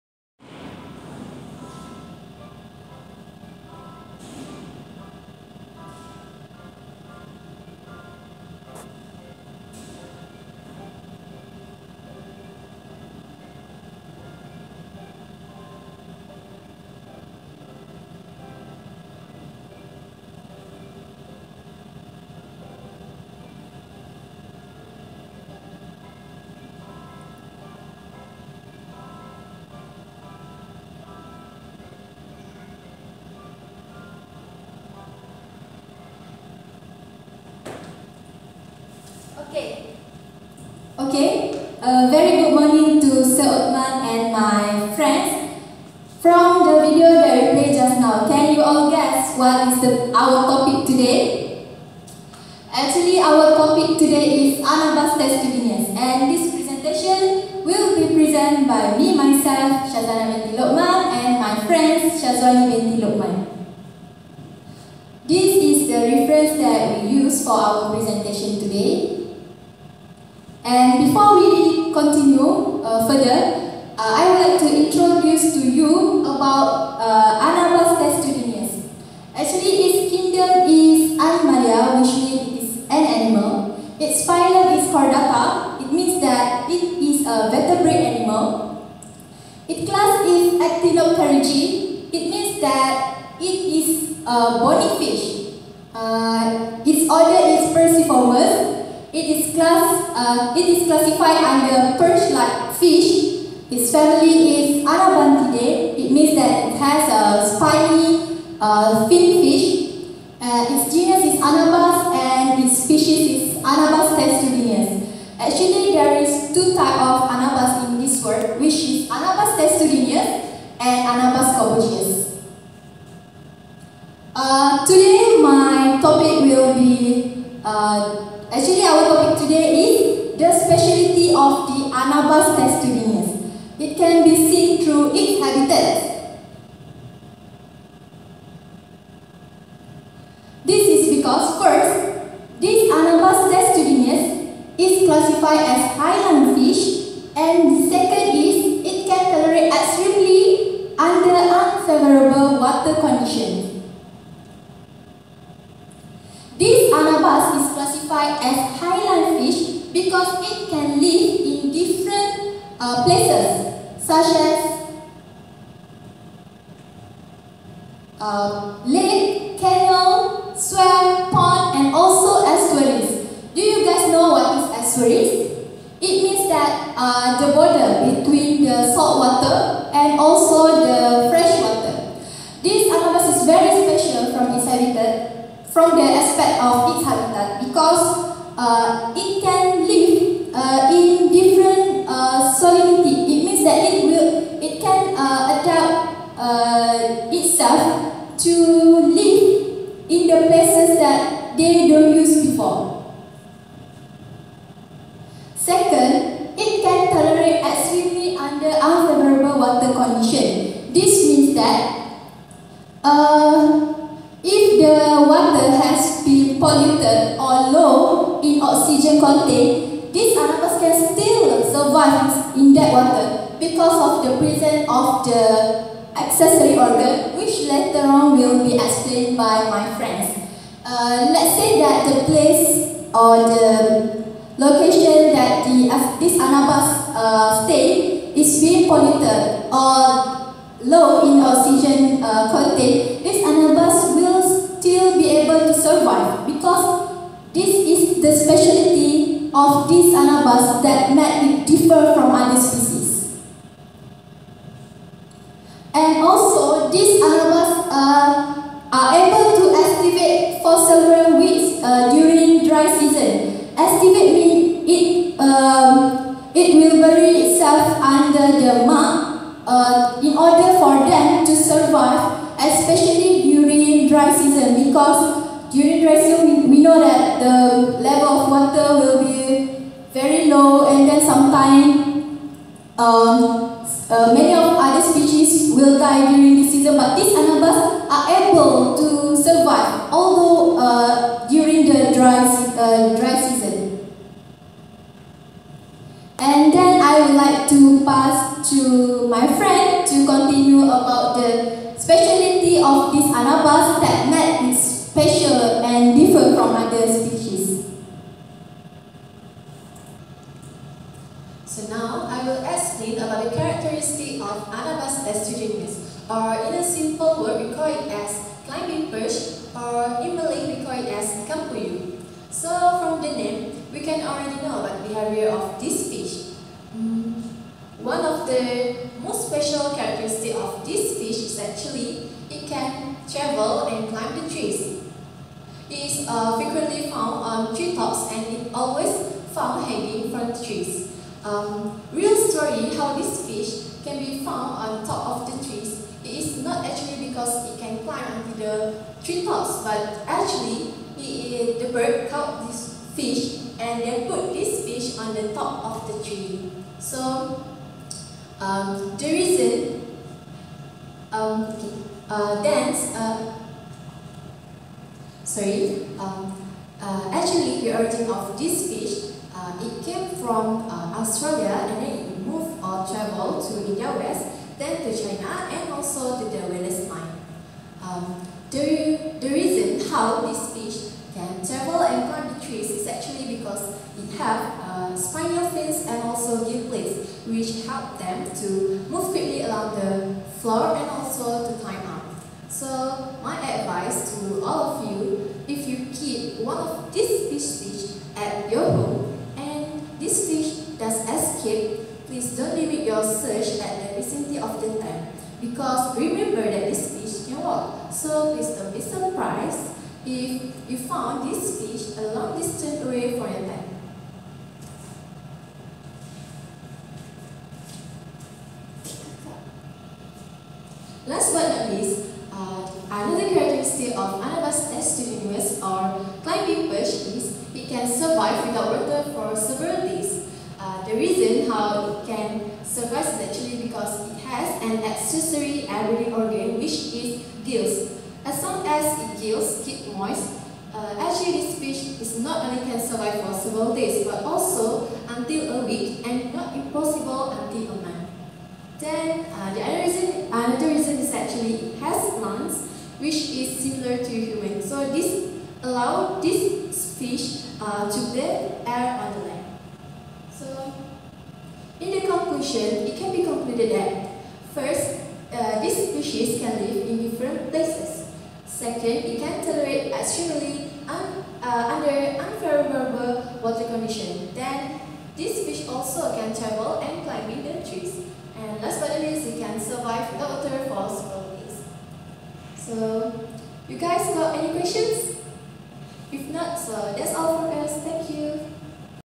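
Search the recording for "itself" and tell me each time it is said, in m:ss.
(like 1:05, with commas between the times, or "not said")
3:17, 4:27.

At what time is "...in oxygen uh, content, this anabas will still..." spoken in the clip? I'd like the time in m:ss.
4:01.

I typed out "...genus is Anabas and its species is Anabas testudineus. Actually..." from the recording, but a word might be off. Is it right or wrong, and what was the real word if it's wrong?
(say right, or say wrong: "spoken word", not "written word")
right.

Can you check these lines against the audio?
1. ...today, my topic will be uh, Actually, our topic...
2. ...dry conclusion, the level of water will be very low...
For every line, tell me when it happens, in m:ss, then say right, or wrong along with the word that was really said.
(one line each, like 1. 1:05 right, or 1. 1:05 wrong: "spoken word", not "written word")
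1. 2:04 right
2. 4:36 wrong: "season", not "conclusion".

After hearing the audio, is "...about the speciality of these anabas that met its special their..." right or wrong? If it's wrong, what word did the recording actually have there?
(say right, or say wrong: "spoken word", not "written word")
right.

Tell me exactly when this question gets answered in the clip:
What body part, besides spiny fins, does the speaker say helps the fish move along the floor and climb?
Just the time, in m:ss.
6:26.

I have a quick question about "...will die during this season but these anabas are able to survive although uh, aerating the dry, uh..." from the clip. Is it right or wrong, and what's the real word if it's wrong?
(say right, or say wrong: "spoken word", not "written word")
wrong: "during", not "aerating".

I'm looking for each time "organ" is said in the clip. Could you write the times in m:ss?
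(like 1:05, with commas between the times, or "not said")
3:46, 7:16.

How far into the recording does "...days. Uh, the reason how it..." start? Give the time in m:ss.
7:10.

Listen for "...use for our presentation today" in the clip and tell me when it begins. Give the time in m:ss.
1:07.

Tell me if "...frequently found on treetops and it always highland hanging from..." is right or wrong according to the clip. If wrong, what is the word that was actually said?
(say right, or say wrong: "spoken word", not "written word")
wrong: "found", not "highland".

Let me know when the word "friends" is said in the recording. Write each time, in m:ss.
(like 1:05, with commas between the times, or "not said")
0:44, 1:01, 3:49, 4:59.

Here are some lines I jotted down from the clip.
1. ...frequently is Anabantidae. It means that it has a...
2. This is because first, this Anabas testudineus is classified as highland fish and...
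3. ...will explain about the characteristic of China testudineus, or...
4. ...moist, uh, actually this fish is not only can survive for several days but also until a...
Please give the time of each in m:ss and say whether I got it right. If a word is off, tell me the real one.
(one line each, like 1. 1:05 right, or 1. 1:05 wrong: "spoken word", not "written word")
1. 1:43 wrong: "family", not "frequently"
2. 2:20 right
3. 5:12 wrong: "Anabas", not "China"
4. 7:20 right.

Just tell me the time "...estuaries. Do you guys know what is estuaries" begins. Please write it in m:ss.
2:52.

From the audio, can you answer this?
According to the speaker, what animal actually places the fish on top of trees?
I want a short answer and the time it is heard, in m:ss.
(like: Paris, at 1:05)
the bird, at 5:51.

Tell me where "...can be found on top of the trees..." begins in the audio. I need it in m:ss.
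5:44.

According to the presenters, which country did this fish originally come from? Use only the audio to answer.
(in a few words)
Australia.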